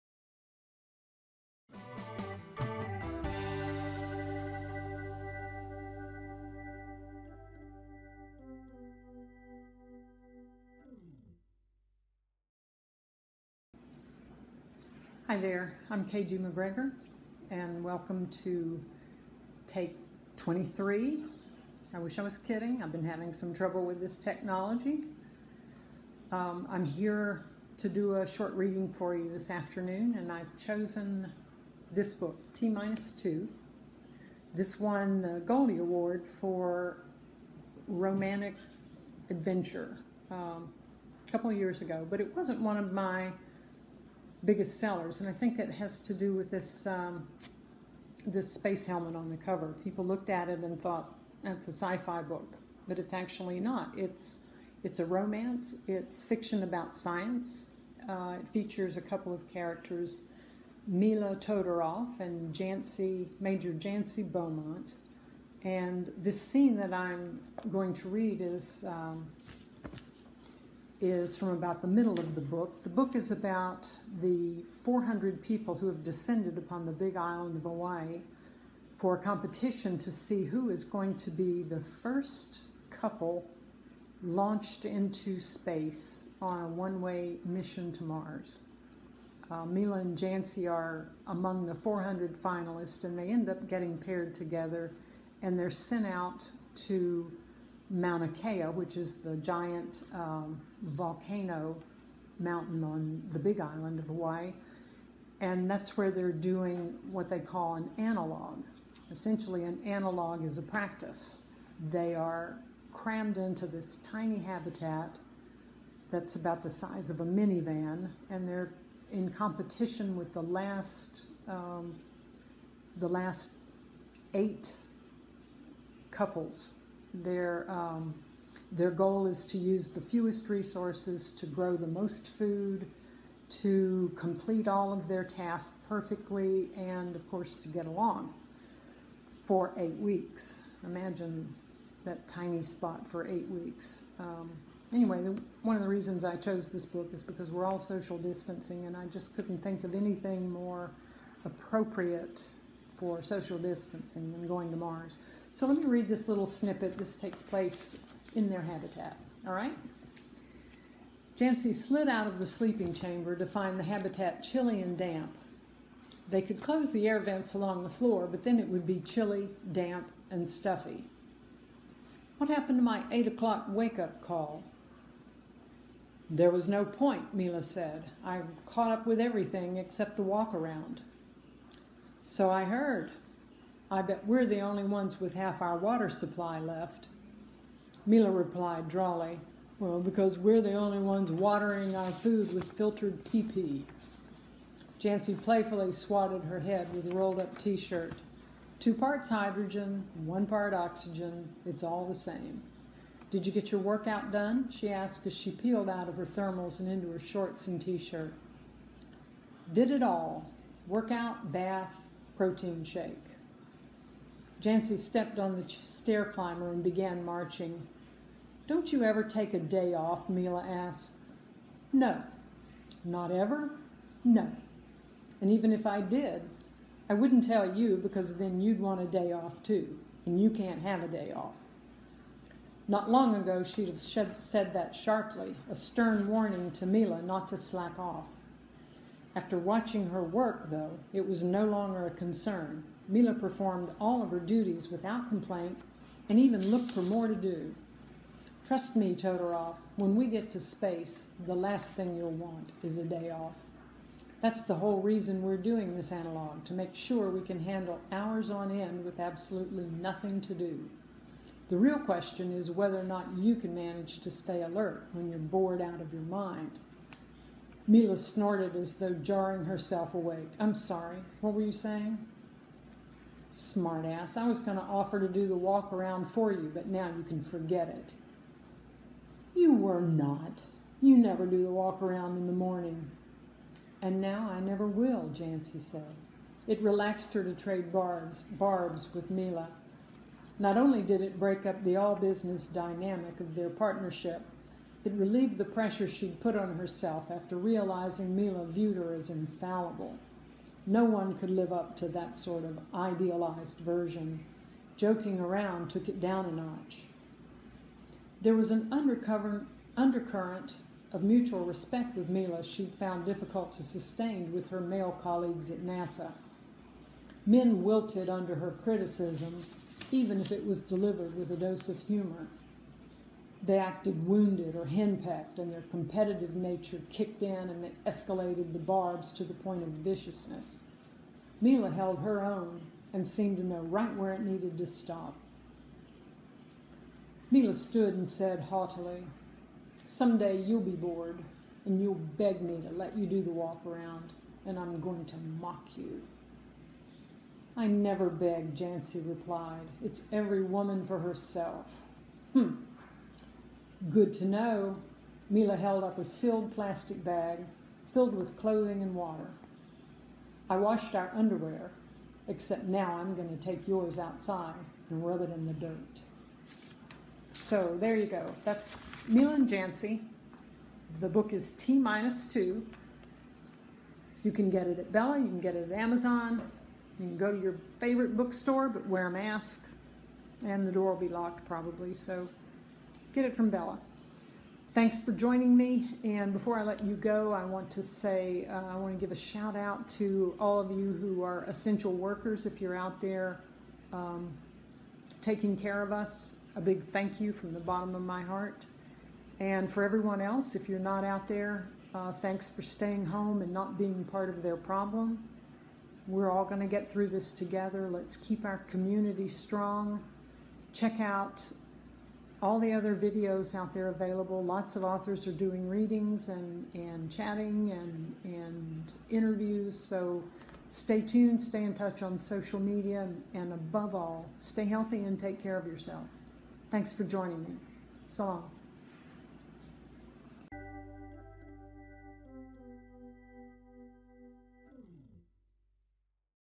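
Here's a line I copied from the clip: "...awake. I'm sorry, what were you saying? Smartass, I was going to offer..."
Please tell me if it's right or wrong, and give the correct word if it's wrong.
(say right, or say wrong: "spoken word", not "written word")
right.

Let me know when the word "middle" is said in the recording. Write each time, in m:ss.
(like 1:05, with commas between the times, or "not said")
1:11.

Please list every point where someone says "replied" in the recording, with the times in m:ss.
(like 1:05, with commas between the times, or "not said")
3:08, 5:49.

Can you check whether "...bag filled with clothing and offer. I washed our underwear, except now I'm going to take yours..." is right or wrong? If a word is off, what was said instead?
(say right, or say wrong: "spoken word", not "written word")
wrong: "water", not "offer".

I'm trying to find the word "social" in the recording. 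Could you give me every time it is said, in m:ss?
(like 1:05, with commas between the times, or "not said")
2:27, 2:33, 7:02.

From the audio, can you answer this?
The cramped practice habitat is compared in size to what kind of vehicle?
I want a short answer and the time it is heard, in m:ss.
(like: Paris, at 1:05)
minivan, at 1:57.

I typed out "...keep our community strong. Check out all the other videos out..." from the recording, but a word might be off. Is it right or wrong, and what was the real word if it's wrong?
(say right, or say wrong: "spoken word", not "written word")
right.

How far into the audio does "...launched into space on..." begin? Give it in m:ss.
1:24.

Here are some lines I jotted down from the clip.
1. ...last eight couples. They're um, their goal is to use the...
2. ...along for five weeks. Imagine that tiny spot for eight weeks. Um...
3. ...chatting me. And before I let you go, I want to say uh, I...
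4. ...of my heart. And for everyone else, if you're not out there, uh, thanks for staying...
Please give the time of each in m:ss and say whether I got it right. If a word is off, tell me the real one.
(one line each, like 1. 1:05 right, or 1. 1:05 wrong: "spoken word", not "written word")
1. 2:03 right
2. 2:17 wrong: "eight", not "five"
3. 6:25 wrong: "joining", not "chatting"
4. 6:38 right.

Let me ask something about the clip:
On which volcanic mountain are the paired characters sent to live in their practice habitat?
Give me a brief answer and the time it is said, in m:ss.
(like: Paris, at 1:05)
Mauna Kea, at 1:37.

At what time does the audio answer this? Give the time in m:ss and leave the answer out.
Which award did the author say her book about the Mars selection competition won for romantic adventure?
0:35.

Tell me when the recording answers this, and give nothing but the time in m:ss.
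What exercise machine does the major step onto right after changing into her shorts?
3:35.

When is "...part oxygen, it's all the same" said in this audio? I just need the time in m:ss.
3:20.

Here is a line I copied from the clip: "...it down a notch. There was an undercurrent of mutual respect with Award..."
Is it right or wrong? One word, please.
wrong.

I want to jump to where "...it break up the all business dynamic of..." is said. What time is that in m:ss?
4:51.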